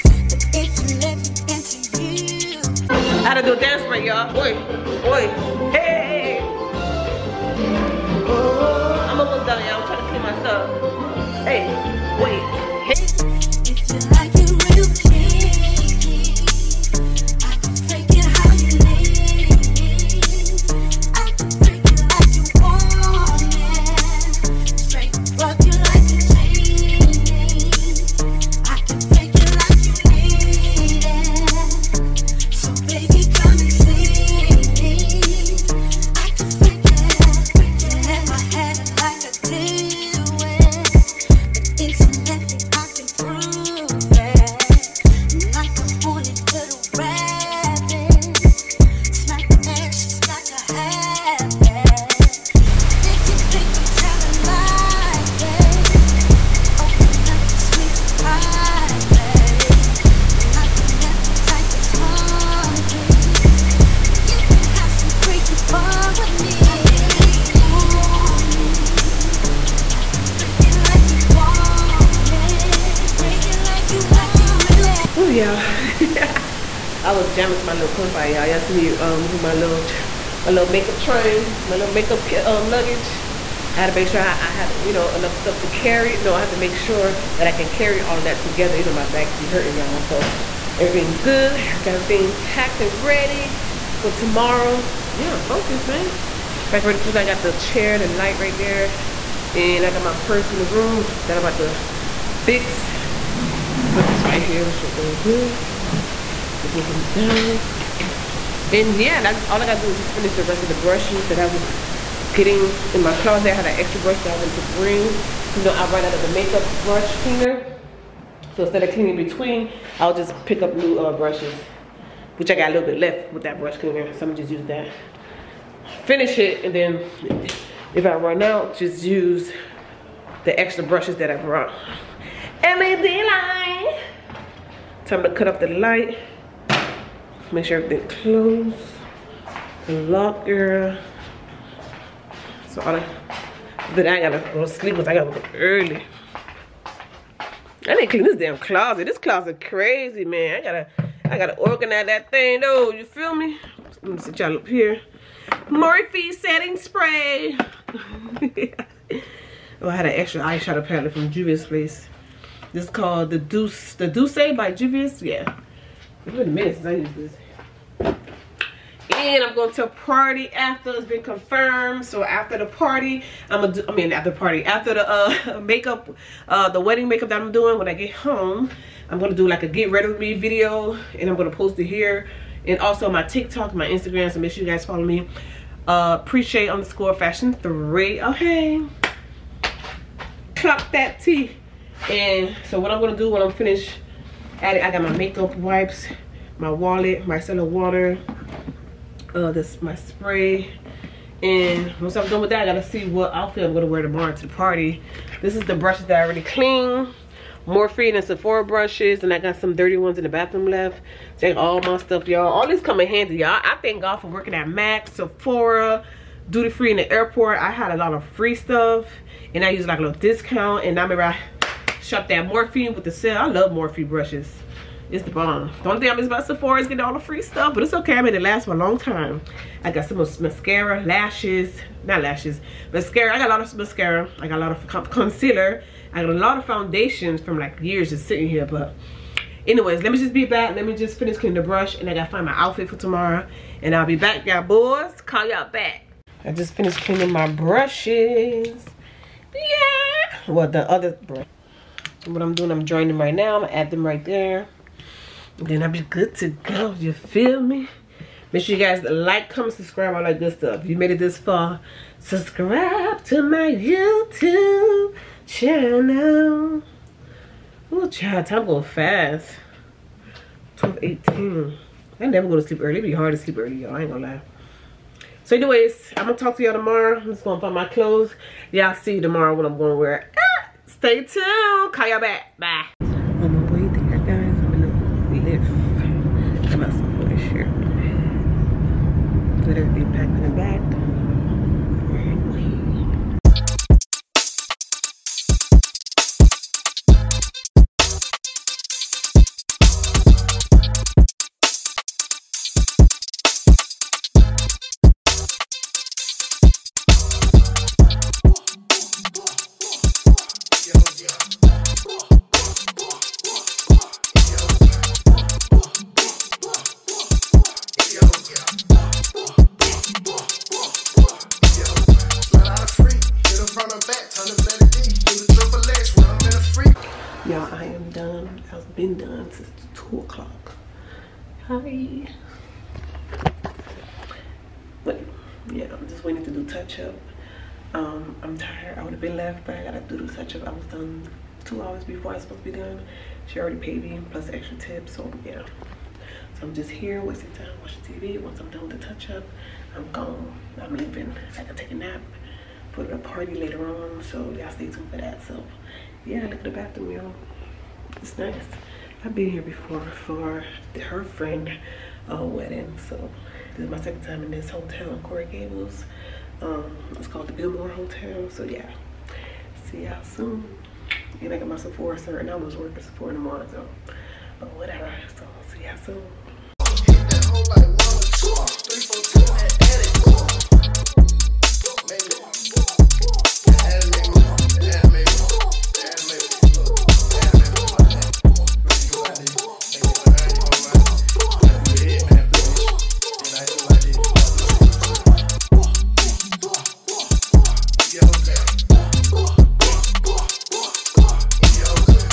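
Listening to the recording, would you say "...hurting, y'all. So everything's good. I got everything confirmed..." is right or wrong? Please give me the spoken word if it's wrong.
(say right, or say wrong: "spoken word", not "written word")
wrong: "packed", not "confirmed".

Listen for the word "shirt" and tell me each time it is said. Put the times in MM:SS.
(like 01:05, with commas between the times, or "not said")
04:47.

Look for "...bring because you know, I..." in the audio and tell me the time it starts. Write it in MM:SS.
01:54.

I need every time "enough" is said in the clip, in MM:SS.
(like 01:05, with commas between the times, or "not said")
01:25.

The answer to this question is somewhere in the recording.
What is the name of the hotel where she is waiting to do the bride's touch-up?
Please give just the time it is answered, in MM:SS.
06:07.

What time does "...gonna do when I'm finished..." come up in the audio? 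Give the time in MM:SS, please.
03:13.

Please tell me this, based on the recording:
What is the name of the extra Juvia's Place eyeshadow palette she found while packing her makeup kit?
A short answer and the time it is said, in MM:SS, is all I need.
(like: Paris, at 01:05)
The Deuce, at 02:43.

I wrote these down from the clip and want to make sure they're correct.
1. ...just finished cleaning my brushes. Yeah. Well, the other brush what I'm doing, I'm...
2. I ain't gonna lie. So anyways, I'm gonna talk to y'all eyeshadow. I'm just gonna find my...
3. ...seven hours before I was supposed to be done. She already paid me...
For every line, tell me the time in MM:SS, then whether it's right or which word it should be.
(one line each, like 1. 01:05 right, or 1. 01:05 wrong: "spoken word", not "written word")
1. 04:06 right
2. 04:33 wrong: "tomorrow", not "eyeshadow"
3. 05:41 wrong: "two", not "seven".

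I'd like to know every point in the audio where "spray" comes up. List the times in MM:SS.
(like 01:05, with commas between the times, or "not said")
02:36, 03:19.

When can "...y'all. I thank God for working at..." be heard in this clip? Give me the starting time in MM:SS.
03:33.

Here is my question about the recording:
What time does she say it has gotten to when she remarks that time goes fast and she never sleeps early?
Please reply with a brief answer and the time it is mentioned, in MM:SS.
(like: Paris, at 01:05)
12:18, at 04:30.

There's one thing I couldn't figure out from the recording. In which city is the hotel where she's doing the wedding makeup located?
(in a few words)
Coral Gables.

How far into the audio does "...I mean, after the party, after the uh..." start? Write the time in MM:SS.
02:53.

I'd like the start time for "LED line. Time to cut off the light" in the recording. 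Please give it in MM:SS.
02:12.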